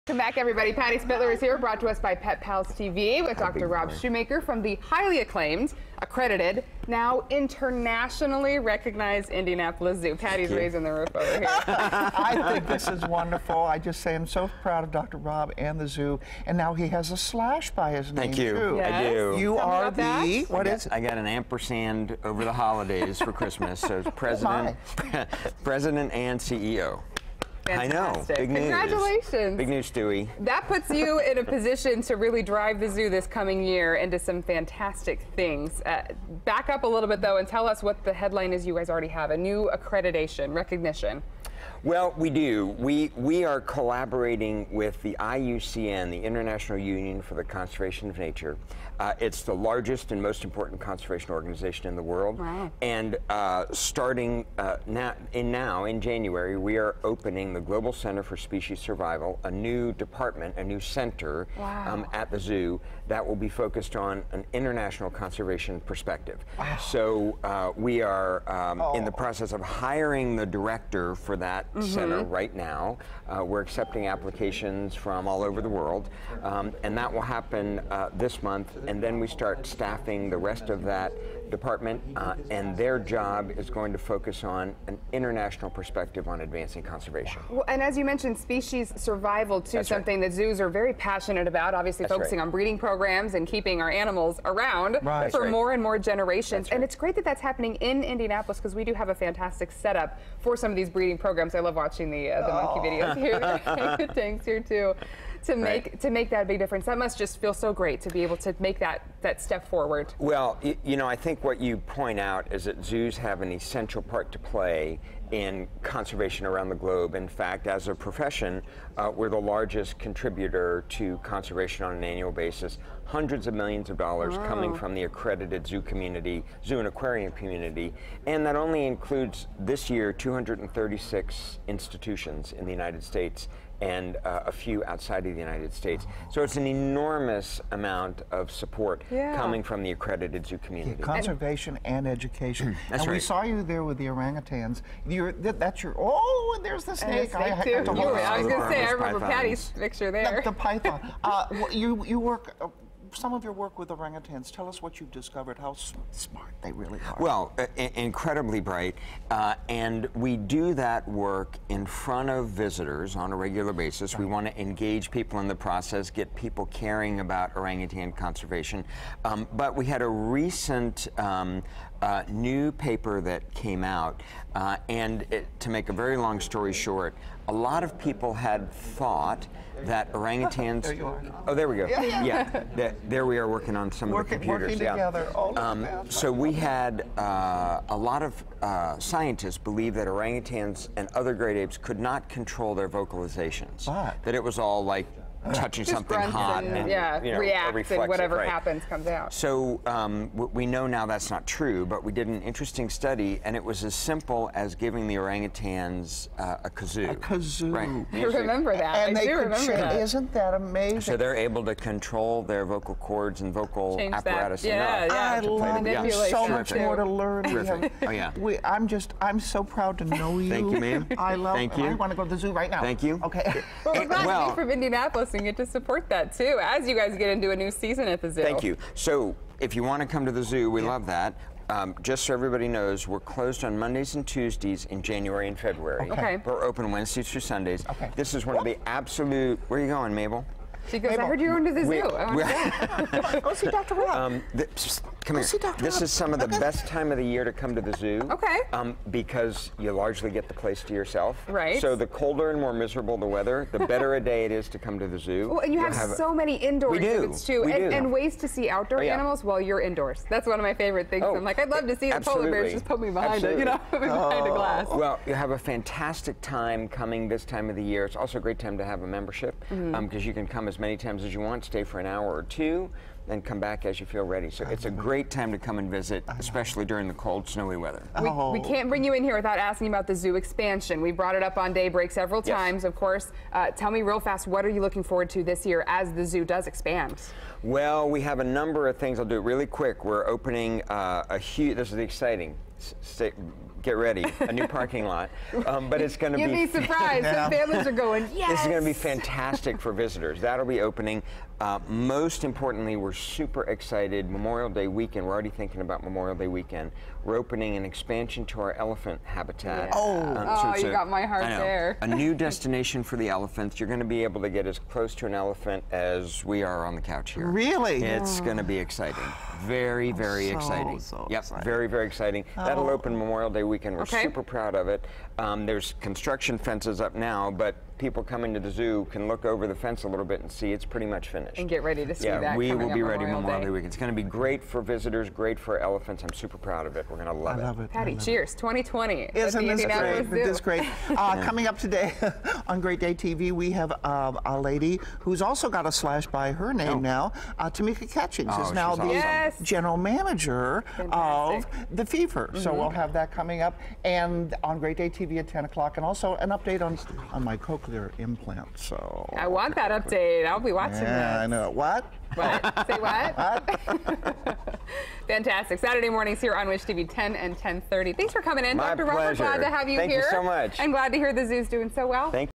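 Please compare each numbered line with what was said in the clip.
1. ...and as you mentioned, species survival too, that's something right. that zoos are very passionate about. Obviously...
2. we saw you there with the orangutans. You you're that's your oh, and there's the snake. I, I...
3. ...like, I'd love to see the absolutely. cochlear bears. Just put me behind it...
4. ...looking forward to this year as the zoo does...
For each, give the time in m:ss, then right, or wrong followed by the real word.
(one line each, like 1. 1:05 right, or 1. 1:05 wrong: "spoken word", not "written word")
1. 1:27 right
2. 2:23 right
3. 4:21 wrong: "polar", not "cochlear"
4. 4:44 right.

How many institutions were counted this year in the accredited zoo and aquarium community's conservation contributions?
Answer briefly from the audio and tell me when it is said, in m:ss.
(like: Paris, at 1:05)
236, at 2:10.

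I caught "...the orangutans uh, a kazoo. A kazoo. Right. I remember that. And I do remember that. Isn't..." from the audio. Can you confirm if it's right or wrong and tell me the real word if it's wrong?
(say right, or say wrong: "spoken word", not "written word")
right.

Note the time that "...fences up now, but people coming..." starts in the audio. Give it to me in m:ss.
5:26.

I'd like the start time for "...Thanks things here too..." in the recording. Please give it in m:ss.
1:44.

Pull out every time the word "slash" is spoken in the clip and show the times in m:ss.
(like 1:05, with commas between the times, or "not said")
0:17, 5:45.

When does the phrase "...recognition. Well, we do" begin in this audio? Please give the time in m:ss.
0:40.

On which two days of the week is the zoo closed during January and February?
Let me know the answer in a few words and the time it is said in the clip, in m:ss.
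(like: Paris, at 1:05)
Mondays and Tuesdays, at 3:53.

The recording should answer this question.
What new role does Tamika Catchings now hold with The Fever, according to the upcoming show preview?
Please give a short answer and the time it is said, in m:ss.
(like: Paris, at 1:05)
General manager, at 5:49.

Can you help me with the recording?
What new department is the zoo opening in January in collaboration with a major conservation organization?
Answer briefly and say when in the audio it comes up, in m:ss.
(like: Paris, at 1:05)
Global Center for Species Survival, at 0:57.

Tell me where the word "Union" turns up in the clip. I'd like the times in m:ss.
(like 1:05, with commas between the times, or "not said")
0:46.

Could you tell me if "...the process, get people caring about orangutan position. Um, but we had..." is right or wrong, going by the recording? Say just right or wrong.
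wrong.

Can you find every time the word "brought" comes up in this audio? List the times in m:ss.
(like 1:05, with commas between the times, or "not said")
0:01, 4:41.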